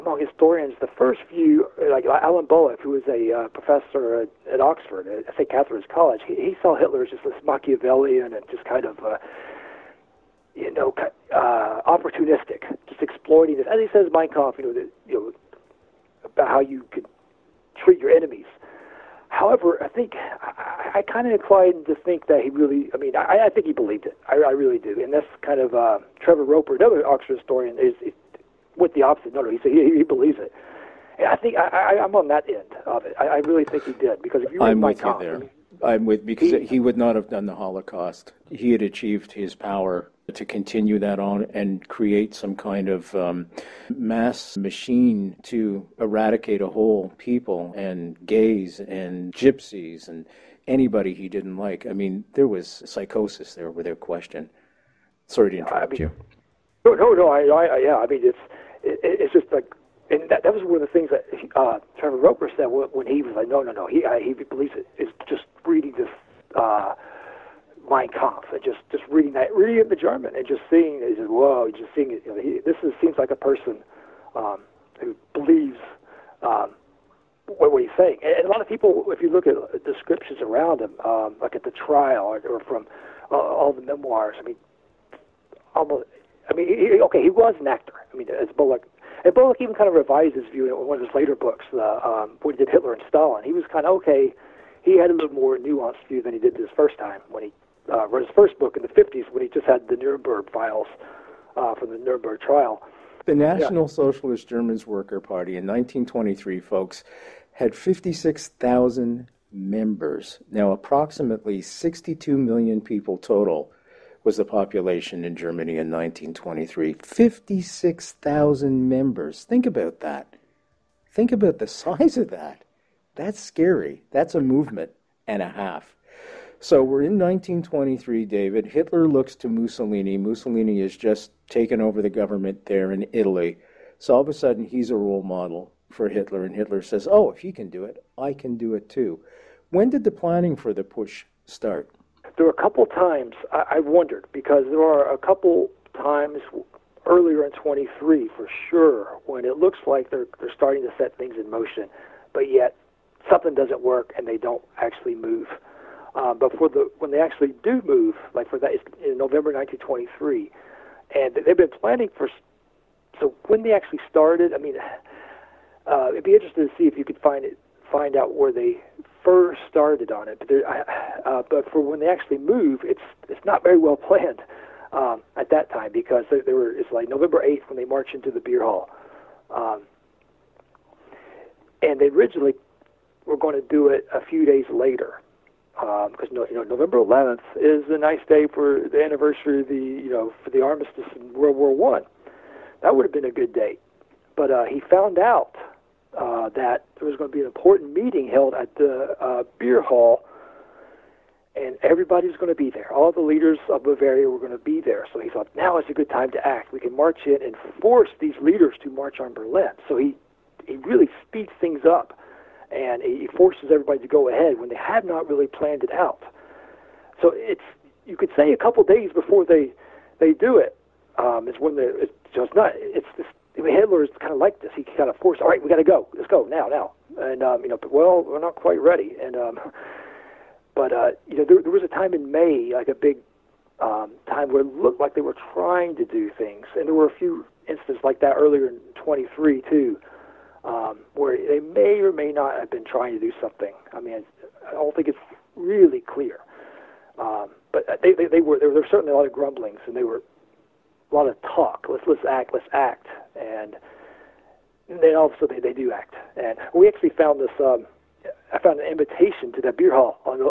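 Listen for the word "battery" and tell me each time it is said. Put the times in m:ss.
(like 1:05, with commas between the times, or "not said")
not said.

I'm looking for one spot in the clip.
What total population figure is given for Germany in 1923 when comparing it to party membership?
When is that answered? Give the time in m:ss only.
1:51.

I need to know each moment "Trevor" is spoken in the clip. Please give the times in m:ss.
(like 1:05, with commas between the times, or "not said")
0:26, 1:01.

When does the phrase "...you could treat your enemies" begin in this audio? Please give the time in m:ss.
0:16.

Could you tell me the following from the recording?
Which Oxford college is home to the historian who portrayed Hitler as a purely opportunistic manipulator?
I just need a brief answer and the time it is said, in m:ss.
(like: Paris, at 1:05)
St. Catherine's College, at 0:05.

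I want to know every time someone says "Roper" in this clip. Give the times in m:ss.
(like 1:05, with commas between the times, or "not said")
0:26, 1:02.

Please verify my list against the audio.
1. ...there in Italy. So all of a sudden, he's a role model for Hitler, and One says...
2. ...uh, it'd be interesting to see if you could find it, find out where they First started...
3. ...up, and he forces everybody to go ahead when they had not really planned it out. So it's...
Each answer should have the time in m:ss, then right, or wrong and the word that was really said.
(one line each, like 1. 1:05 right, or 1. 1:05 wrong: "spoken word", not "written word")
1. 2:12 wrong: "Hitler", not "One"
2. 2:45 right
3. 3:31 right.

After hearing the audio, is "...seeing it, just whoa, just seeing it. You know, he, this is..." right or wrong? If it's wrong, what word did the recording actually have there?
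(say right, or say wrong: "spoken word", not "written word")
right.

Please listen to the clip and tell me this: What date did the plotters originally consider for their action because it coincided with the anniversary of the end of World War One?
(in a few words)
November 11th.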